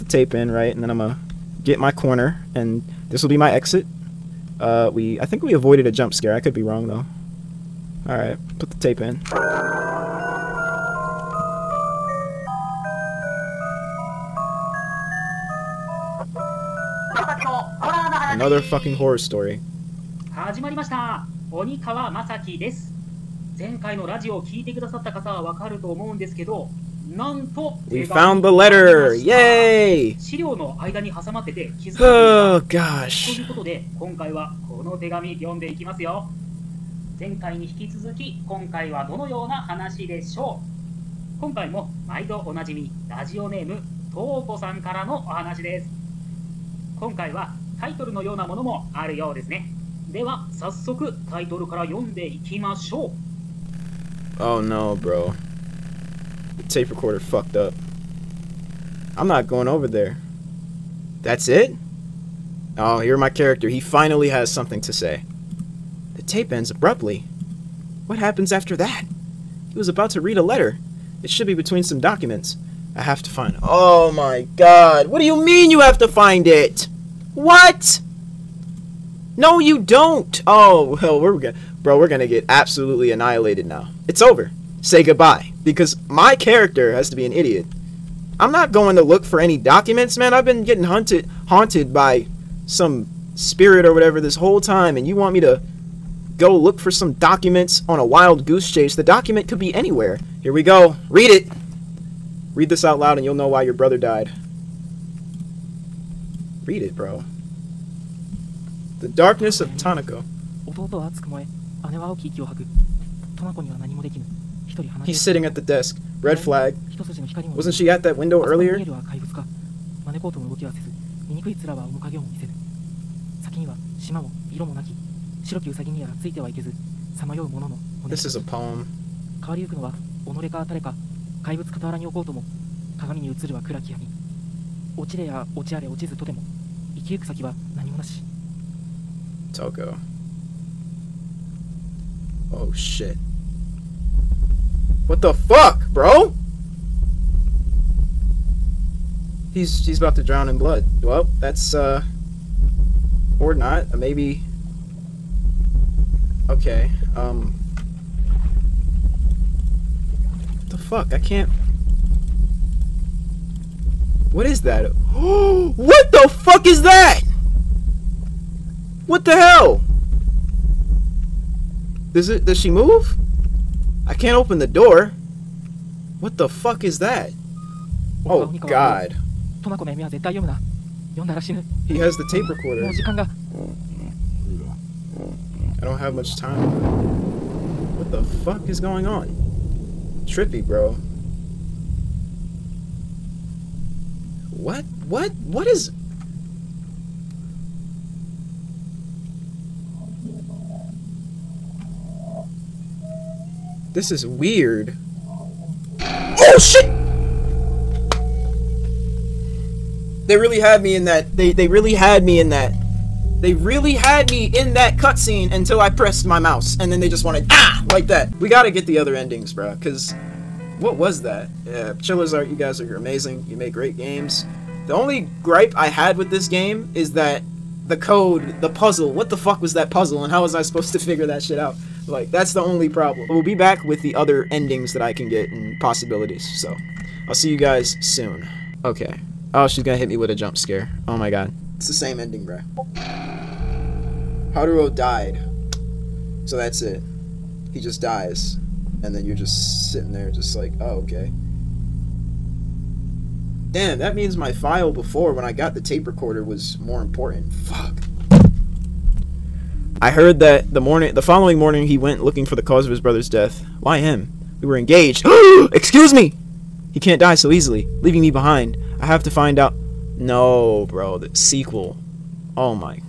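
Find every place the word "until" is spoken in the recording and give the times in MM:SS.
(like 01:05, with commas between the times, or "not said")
03:35.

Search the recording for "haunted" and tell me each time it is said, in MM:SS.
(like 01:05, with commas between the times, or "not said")
01:31.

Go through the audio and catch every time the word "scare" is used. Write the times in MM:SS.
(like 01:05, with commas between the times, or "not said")
00:06, 04:00.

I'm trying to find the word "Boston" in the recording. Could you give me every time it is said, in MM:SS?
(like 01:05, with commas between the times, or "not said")
not said.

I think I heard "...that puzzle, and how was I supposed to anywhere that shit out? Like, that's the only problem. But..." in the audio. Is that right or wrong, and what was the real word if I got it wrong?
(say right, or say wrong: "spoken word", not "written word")
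wrong: "figure", not "anywhere".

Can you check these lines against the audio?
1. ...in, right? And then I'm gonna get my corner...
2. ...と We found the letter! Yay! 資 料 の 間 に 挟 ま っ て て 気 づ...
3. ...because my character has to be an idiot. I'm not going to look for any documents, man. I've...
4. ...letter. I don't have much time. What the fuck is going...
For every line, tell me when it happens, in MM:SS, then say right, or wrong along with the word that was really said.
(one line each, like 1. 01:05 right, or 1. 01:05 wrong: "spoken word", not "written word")
1. 00:00 right
2. 00:27 right
3. 01:25 right
4. 03:02 wrong: "recorder", not "letter".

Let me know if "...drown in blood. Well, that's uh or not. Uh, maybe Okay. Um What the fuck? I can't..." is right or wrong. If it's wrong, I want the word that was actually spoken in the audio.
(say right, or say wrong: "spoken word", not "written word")
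right.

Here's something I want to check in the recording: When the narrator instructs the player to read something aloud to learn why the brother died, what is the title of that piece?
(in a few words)
The Darkness of Tanako.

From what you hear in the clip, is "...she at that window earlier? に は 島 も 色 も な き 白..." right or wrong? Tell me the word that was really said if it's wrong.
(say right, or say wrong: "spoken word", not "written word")
right.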